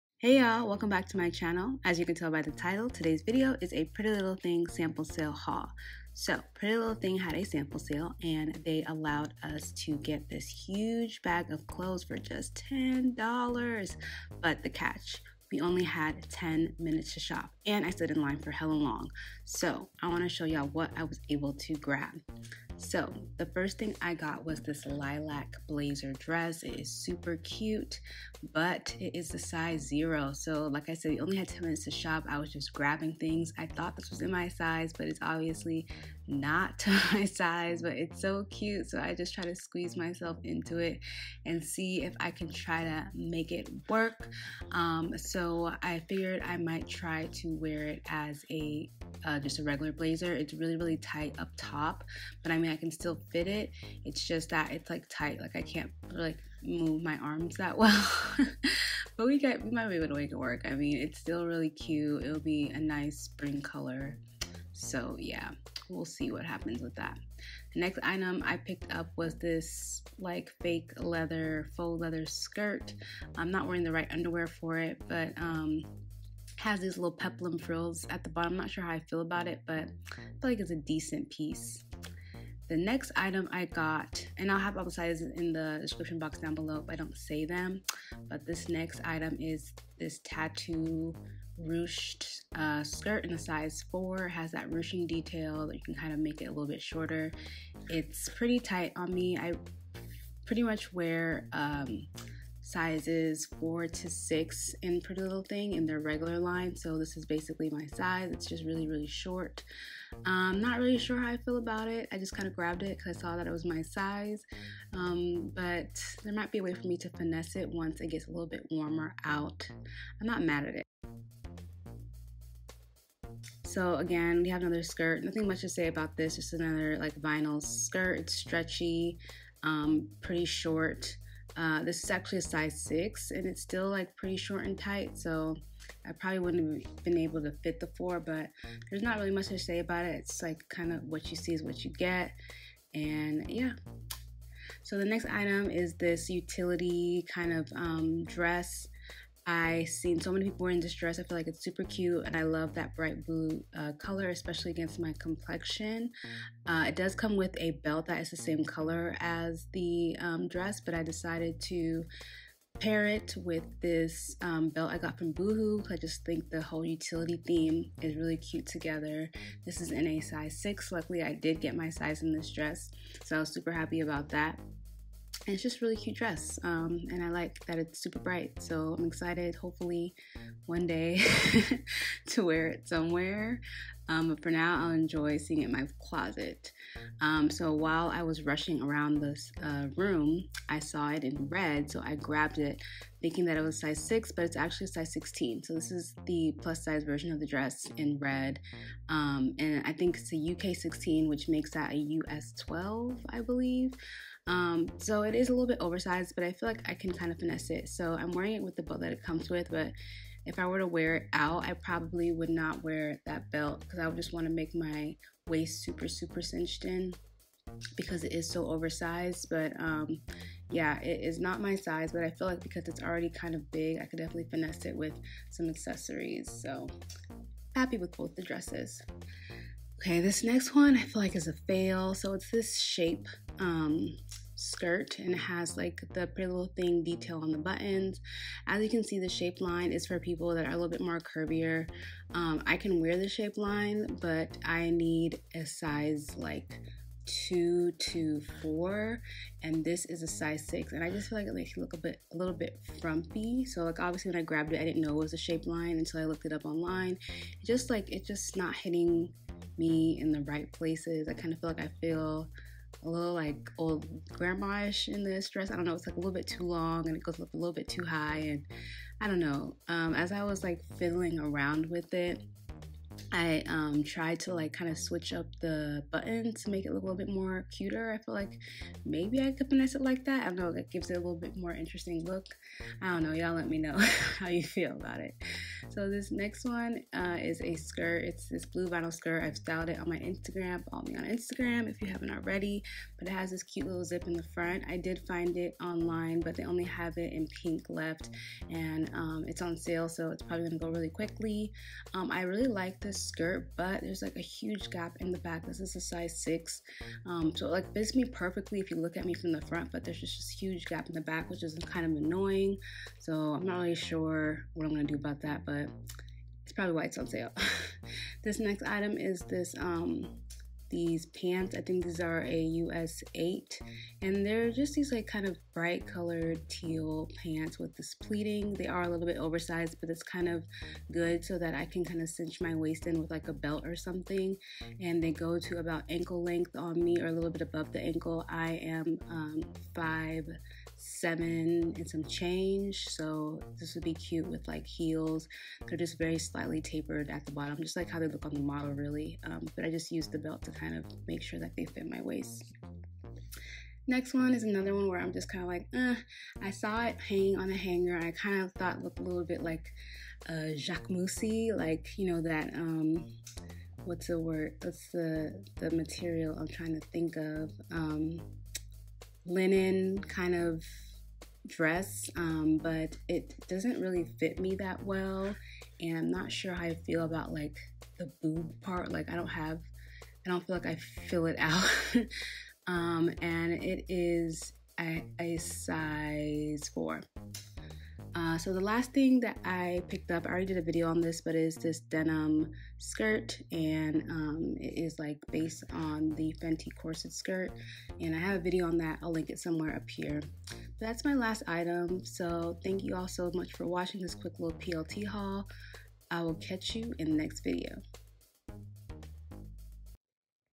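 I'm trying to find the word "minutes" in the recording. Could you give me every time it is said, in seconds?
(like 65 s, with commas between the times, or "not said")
16 s, 31 s.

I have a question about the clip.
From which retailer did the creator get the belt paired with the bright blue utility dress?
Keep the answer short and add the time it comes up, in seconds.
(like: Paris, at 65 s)
Boohoo, at 165 s.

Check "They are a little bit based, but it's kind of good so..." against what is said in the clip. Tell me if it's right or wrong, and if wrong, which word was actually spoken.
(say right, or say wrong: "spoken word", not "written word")
wrong: "oversized", not "based".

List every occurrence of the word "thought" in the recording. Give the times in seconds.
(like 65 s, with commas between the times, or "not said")
33 s, 358 s.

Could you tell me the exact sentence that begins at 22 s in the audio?
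So the first thing I got was this lilac blazer dress.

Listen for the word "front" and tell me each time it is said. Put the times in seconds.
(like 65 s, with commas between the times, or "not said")
294 s, 309 s.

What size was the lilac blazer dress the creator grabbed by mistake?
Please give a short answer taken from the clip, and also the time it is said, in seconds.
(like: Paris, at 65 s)
0, at 29 s.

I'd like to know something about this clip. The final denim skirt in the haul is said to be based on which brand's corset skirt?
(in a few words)
Fenty.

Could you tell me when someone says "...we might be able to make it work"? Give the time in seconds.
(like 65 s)
59 s.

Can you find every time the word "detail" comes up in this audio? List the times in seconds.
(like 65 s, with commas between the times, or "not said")
95 s, 237 s.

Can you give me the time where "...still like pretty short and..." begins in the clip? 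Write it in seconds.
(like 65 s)
133 s.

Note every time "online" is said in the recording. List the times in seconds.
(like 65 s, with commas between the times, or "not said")
256 s, 295 s.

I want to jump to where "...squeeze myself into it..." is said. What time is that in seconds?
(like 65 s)
39 s.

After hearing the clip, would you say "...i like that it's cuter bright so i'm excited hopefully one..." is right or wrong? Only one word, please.
wrong.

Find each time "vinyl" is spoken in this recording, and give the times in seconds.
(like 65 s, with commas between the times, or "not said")
127 s, 288 s.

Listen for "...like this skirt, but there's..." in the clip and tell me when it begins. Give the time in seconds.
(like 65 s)
302 s.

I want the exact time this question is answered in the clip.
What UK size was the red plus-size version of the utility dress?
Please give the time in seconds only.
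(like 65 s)
200 s.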